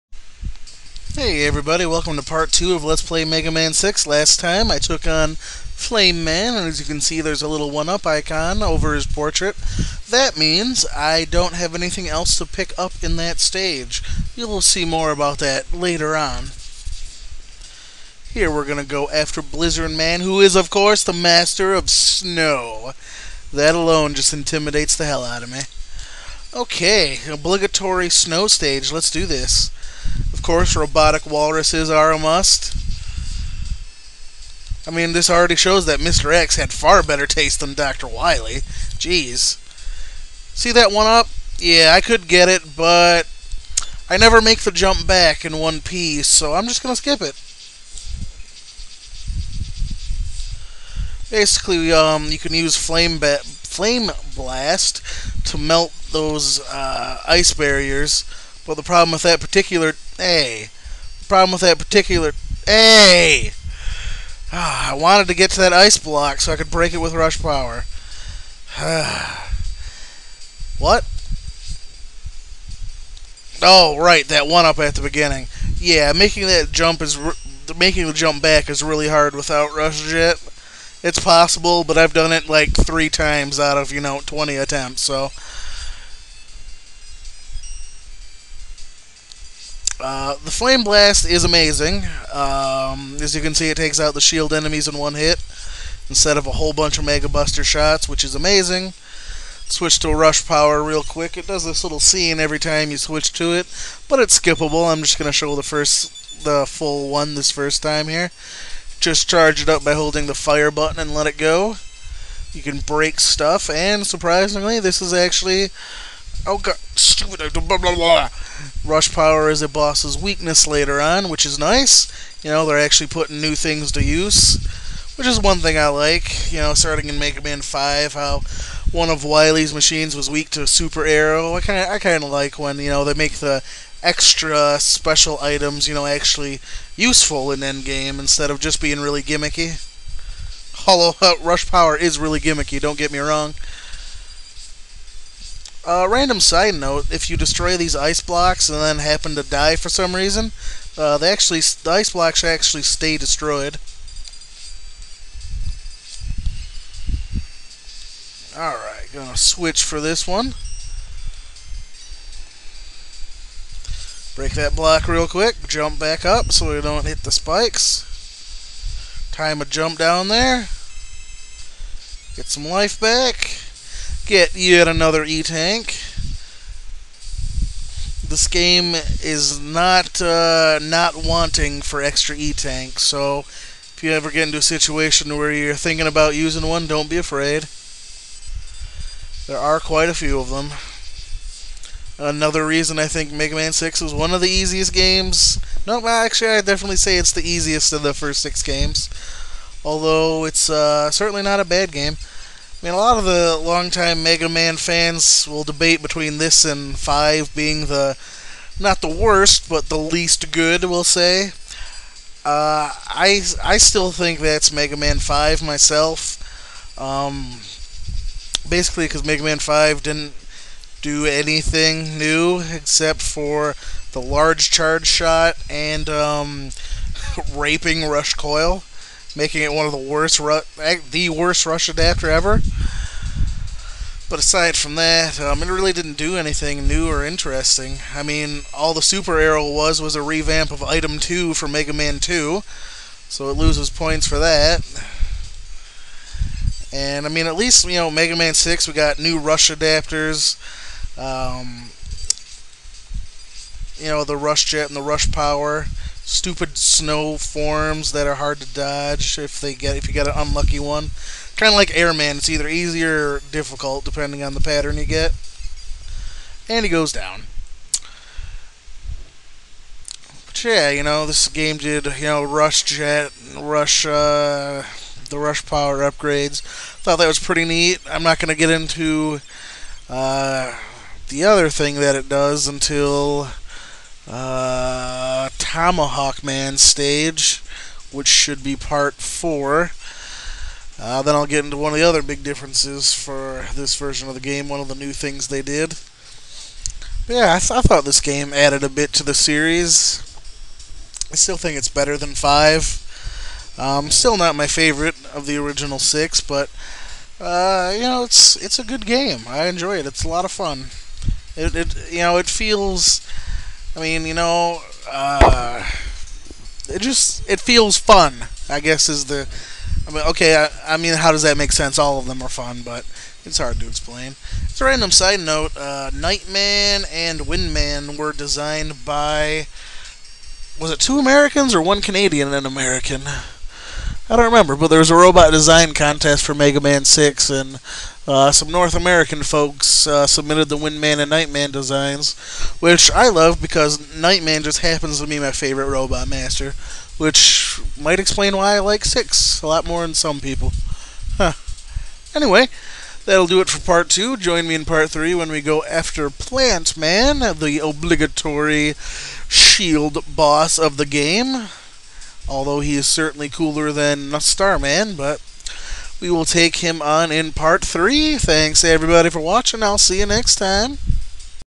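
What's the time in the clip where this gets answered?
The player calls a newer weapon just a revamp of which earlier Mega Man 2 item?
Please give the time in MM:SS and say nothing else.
04:00.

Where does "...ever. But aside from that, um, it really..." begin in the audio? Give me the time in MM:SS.
03:52.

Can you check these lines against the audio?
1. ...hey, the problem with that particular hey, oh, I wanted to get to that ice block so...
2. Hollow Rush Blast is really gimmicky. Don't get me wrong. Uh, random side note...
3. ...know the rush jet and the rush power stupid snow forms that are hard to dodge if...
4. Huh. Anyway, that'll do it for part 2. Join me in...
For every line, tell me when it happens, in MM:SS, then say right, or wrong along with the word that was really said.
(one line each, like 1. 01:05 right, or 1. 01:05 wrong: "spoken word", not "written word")
1. 01:00 right
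2. 02:20 wrong: "Power", not "Blast"
3. 04:14 right
4. 05:51 right.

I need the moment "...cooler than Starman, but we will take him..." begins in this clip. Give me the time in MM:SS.
06:03.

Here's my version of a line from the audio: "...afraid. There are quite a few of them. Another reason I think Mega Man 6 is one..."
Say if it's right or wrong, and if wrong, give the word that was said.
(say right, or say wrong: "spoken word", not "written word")
right.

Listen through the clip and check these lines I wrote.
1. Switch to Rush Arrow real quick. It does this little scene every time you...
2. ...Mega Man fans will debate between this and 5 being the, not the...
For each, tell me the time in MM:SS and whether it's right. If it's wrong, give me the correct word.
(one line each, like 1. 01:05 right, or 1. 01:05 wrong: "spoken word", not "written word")
1. 01:39 wrong: "Power", not "Arrow"
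2. 03:24 right.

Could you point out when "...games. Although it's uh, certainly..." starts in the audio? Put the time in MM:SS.
03:18.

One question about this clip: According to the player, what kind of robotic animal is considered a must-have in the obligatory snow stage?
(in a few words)
Walruses.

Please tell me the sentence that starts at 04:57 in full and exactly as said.
But yeah, I, th I thought this game added a bit to the series.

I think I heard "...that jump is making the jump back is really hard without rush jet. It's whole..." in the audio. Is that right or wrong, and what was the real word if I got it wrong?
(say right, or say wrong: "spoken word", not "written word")
wrong: "possible", not "whole".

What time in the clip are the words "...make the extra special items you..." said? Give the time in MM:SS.
02:13.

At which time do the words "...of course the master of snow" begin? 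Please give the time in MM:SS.
00:20.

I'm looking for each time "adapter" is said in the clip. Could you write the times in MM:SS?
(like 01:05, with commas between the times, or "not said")
03:51, 04:09.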